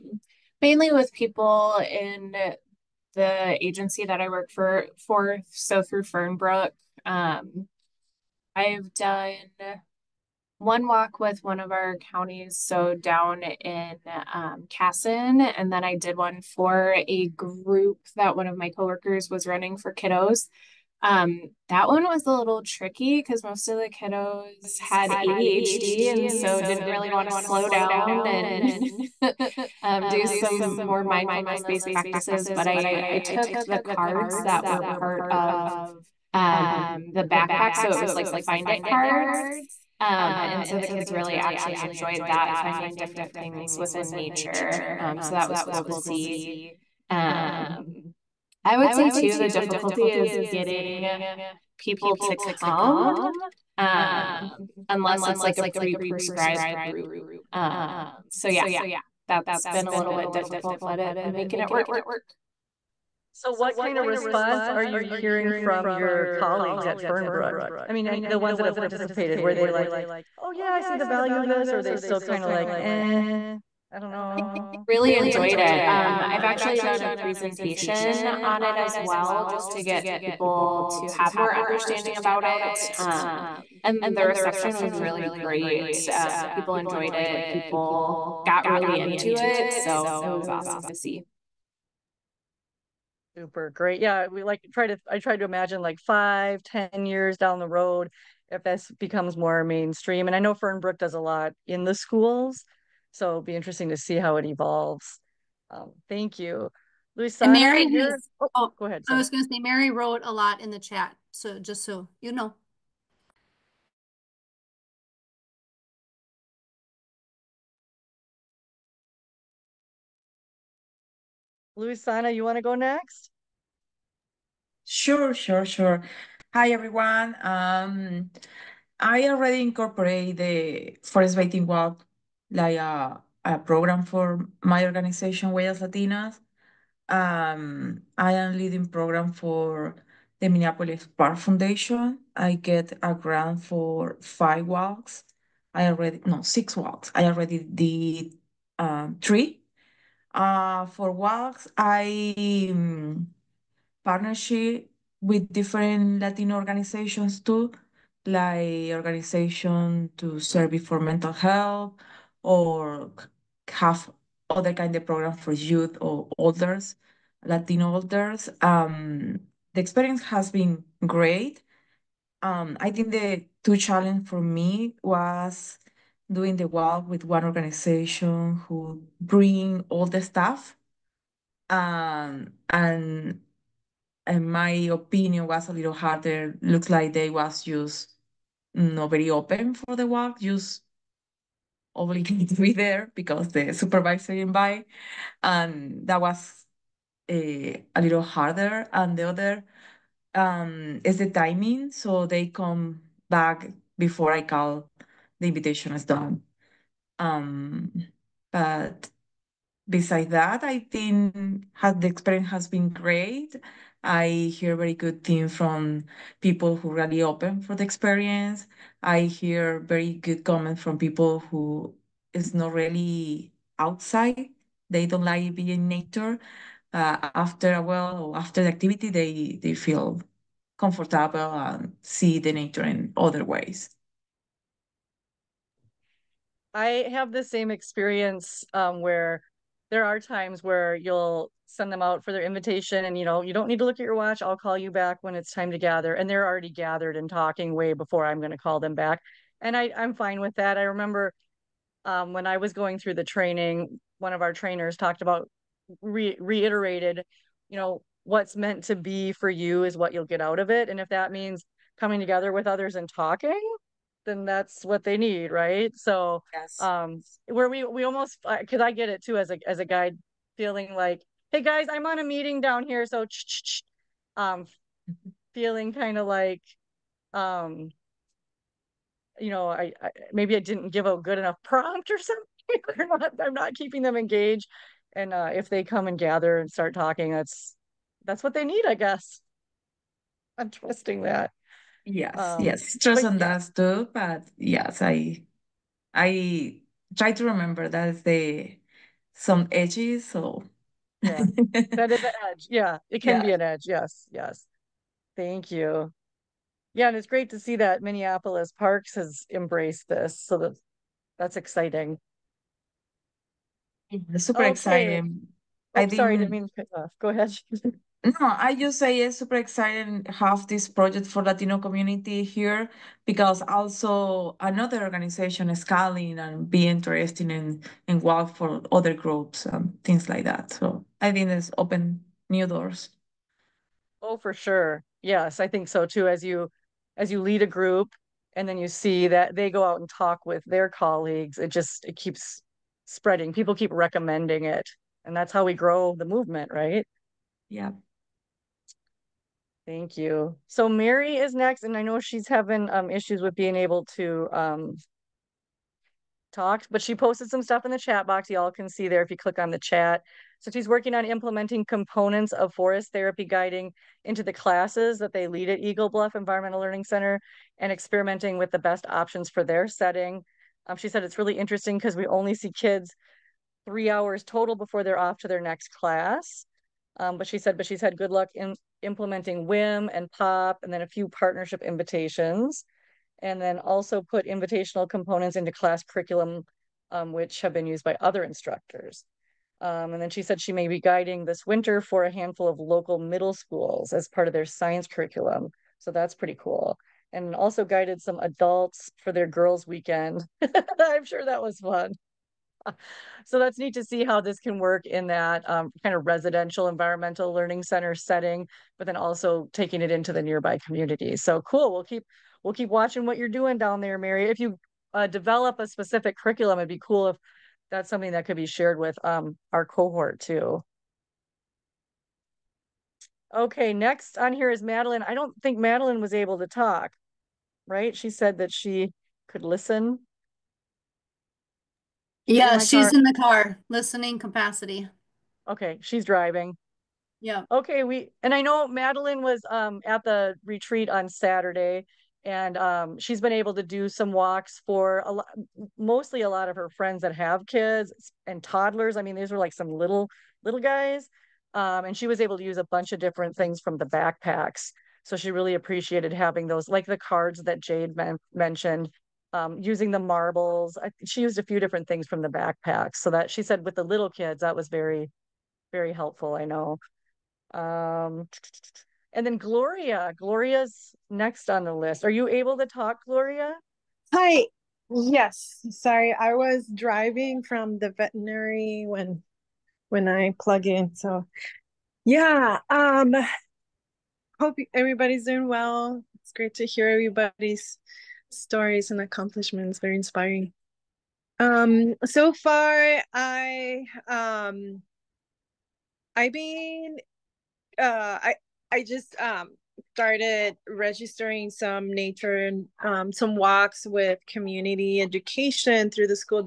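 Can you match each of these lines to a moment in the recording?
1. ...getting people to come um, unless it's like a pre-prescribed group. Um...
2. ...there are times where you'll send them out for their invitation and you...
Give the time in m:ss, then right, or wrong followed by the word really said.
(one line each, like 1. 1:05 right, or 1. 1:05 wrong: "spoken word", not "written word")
1. 0:50 right
2. 3:59 right.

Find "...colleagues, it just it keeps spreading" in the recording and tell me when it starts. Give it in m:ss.
5:40.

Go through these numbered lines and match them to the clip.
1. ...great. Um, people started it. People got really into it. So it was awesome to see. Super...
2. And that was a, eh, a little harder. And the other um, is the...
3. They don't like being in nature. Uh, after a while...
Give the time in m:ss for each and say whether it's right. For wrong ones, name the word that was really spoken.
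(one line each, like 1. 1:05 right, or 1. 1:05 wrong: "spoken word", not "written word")
1. 1:25 wrong: "enjoyed", not "started"
2. 3:15 right
3. 3:44 right.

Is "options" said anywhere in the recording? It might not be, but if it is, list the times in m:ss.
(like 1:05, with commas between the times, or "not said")
6:09.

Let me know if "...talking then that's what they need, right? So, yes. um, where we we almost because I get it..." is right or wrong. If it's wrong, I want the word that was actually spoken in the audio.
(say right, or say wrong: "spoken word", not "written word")
right.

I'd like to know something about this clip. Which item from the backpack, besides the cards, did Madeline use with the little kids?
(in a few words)
marbles.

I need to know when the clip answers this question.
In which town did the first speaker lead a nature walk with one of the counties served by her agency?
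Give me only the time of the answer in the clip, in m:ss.
0:14.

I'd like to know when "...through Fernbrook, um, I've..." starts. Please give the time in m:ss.
0:05.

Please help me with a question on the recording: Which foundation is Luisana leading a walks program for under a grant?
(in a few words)
Minneapolis Park Foundation.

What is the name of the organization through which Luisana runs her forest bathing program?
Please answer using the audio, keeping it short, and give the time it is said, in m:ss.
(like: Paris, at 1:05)
Huellas Latinas, at 2:15.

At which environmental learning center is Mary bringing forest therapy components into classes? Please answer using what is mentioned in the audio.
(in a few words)
Eagle Bluff.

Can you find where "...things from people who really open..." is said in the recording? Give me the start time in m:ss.
3:35.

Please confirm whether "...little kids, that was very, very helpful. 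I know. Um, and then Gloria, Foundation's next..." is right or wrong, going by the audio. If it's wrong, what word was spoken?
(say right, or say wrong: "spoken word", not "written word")
wrong: "Gloria", not "Foundation".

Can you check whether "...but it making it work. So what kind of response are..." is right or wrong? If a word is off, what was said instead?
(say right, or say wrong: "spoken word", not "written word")
right.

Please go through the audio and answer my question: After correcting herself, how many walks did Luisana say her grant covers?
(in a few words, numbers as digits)
6.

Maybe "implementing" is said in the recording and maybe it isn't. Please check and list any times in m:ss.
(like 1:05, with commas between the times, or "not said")
6:01, 6:19.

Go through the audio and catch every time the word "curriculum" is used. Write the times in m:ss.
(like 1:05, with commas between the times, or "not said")
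6:26, 6:35, 6:56.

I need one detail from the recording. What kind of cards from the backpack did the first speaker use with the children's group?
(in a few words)
find it cards.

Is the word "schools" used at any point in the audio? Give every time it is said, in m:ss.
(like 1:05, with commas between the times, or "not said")
1:41, 6:33.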